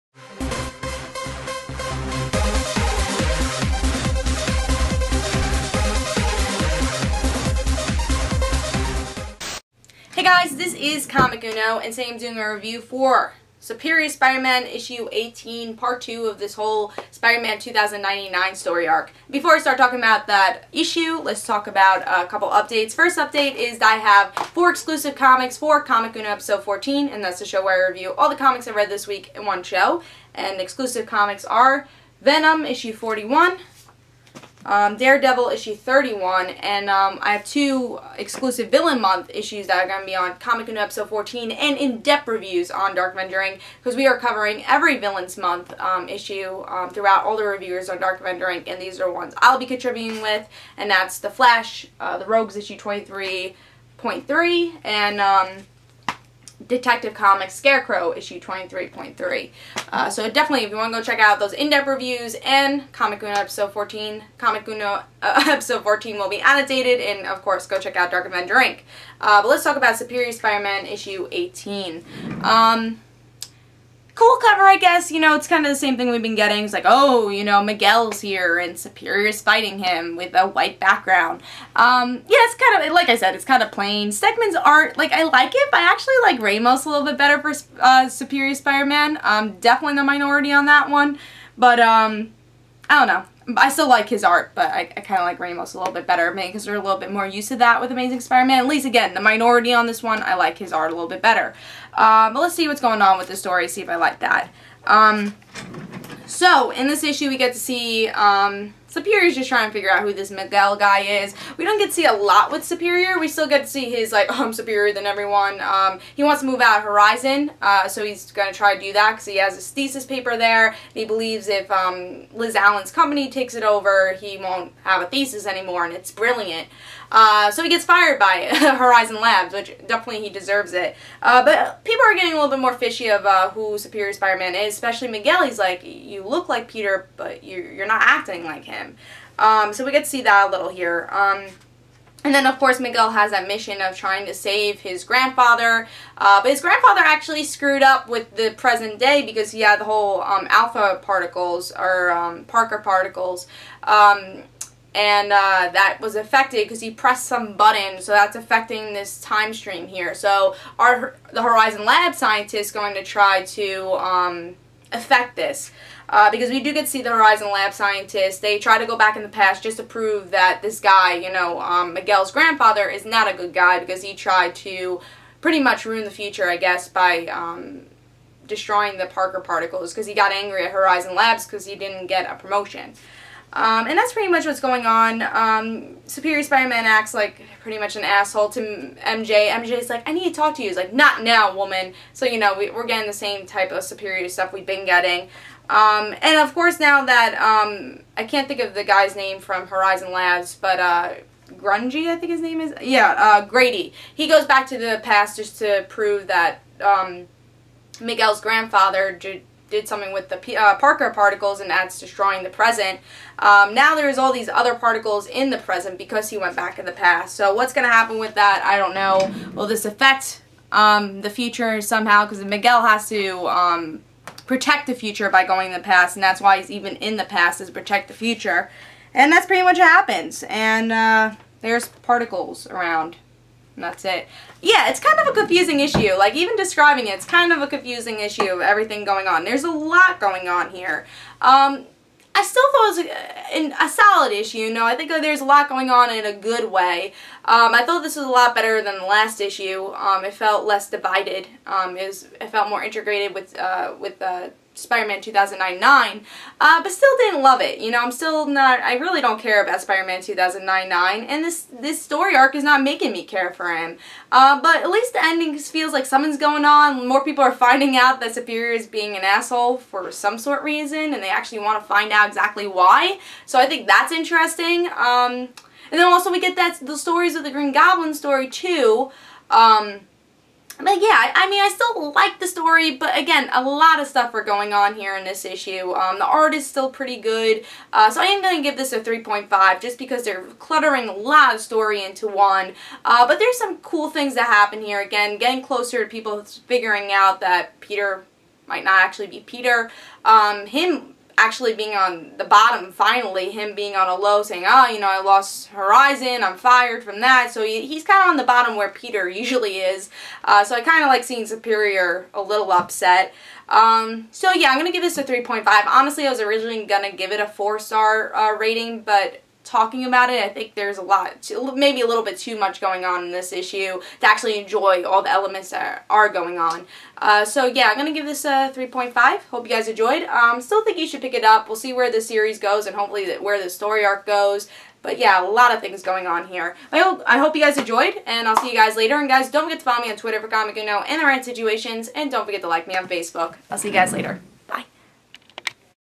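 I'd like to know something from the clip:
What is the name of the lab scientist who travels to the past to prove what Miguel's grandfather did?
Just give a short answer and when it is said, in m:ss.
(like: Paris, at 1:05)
Grady, at 3:23.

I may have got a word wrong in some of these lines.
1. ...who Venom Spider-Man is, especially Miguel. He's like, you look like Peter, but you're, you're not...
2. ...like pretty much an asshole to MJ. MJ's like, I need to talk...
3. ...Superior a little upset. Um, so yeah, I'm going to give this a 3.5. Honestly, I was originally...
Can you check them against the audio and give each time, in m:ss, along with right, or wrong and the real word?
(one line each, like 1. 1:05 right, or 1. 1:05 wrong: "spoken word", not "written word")
1. 2:13 wrong: "Superior", not "Venom"
2. 3:07 right
3. 5:11 right.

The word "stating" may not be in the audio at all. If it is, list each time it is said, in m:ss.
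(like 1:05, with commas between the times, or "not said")
not said.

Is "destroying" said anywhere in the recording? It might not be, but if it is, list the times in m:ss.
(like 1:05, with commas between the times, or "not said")
2:58, 3:31.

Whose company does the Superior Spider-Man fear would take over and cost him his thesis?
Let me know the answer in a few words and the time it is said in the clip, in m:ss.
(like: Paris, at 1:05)
Liz Allan, at 2:02.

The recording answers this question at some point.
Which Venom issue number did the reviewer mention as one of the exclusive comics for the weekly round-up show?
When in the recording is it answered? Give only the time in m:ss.
0:32.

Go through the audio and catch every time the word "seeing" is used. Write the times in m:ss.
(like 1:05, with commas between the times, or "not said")
5:11.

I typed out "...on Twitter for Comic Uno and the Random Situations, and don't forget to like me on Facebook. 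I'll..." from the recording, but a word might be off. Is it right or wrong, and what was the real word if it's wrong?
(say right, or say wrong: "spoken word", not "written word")
right.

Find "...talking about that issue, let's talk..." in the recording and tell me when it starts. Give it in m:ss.
0:19.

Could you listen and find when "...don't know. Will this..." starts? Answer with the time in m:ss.
3:38.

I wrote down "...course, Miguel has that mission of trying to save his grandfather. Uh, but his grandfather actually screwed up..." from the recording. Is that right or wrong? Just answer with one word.
right.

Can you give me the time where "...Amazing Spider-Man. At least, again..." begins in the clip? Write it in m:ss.
1:37.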